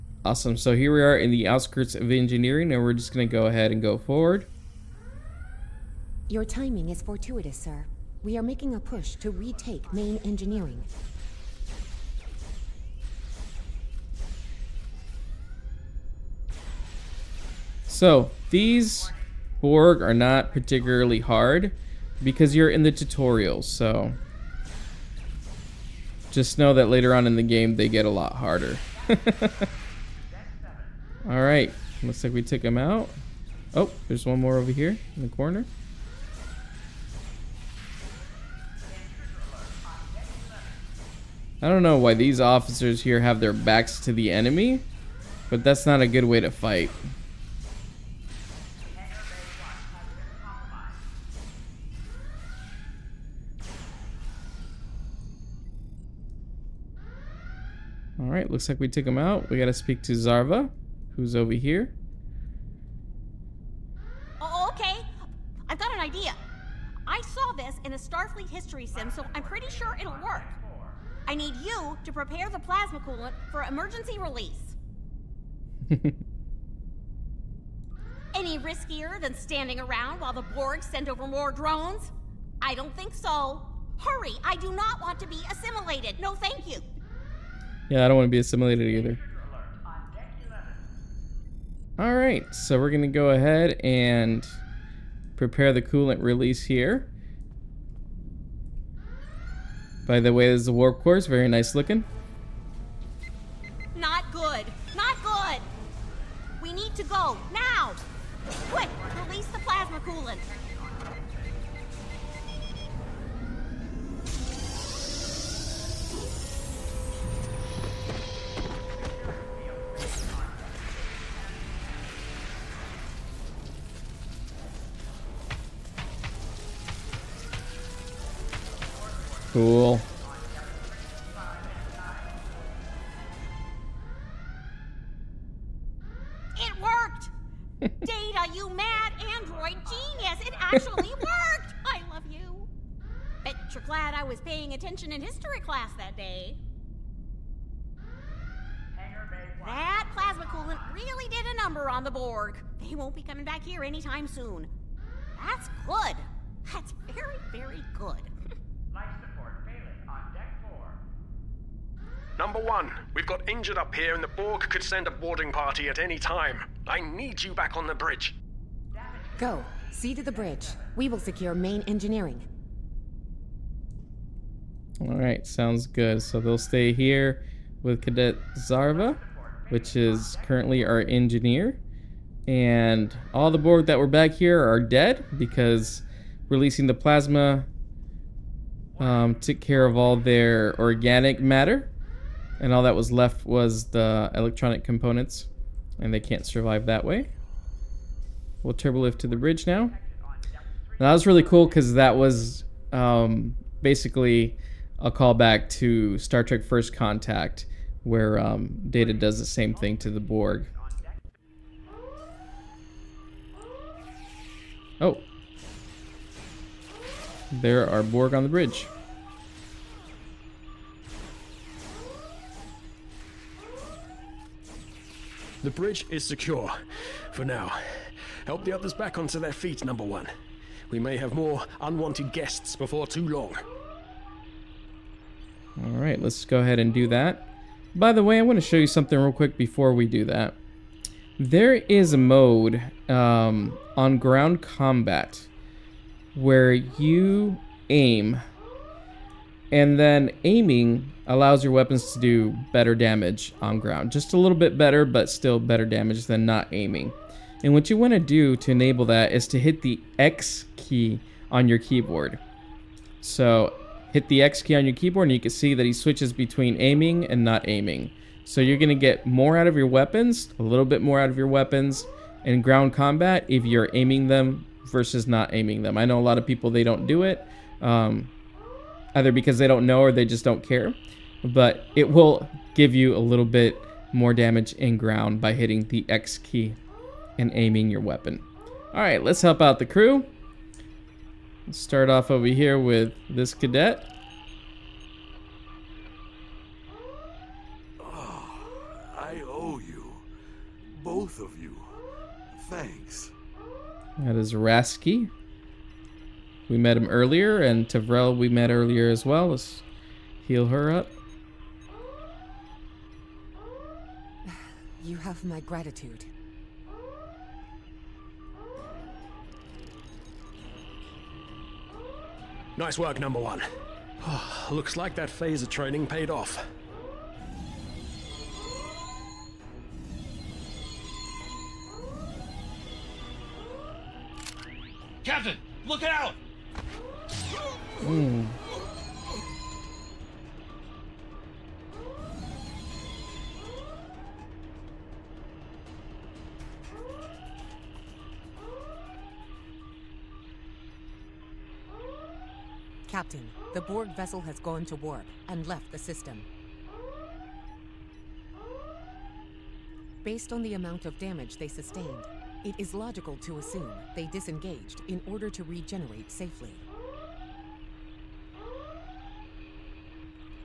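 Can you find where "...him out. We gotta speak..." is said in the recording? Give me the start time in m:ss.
0:59.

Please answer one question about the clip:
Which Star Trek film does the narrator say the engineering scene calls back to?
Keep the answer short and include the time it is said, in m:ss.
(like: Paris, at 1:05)
Star Trek First Contact, at 3:26.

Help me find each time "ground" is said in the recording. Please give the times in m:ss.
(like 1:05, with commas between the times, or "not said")
4:04, 4:13, 4:32, 4:44.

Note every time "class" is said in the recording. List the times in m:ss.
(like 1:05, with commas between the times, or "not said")
2:25.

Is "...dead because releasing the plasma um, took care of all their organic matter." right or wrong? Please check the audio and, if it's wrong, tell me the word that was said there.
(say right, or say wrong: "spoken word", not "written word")
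right.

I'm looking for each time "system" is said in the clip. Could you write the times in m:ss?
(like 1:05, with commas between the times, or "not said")
5:55.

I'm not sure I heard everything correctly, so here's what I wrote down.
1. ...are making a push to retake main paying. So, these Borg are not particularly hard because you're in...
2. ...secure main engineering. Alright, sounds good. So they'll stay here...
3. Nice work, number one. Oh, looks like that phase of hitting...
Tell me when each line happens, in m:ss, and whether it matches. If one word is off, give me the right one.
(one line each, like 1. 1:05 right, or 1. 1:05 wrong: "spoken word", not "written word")
1. 0:08 wrong: "engineering", not "paying"
2. 2:51 right
3. 5:22 wrong: "training", not "hitting".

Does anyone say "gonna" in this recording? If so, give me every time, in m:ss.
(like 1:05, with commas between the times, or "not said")
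0:03.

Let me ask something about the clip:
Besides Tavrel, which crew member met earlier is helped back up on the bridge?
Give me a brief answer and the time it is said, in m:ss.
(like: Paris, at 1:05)
Rasky, at 5:04.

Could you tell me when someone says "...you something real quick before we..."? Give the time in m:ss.
3:58.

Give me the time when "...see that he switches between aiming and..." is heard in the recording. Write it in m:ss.
4:25.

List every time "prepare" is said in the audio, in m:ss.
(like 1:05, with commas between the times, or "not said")
1:12, 1:35.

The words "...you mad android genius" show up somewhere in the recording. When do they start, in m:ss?
2:18.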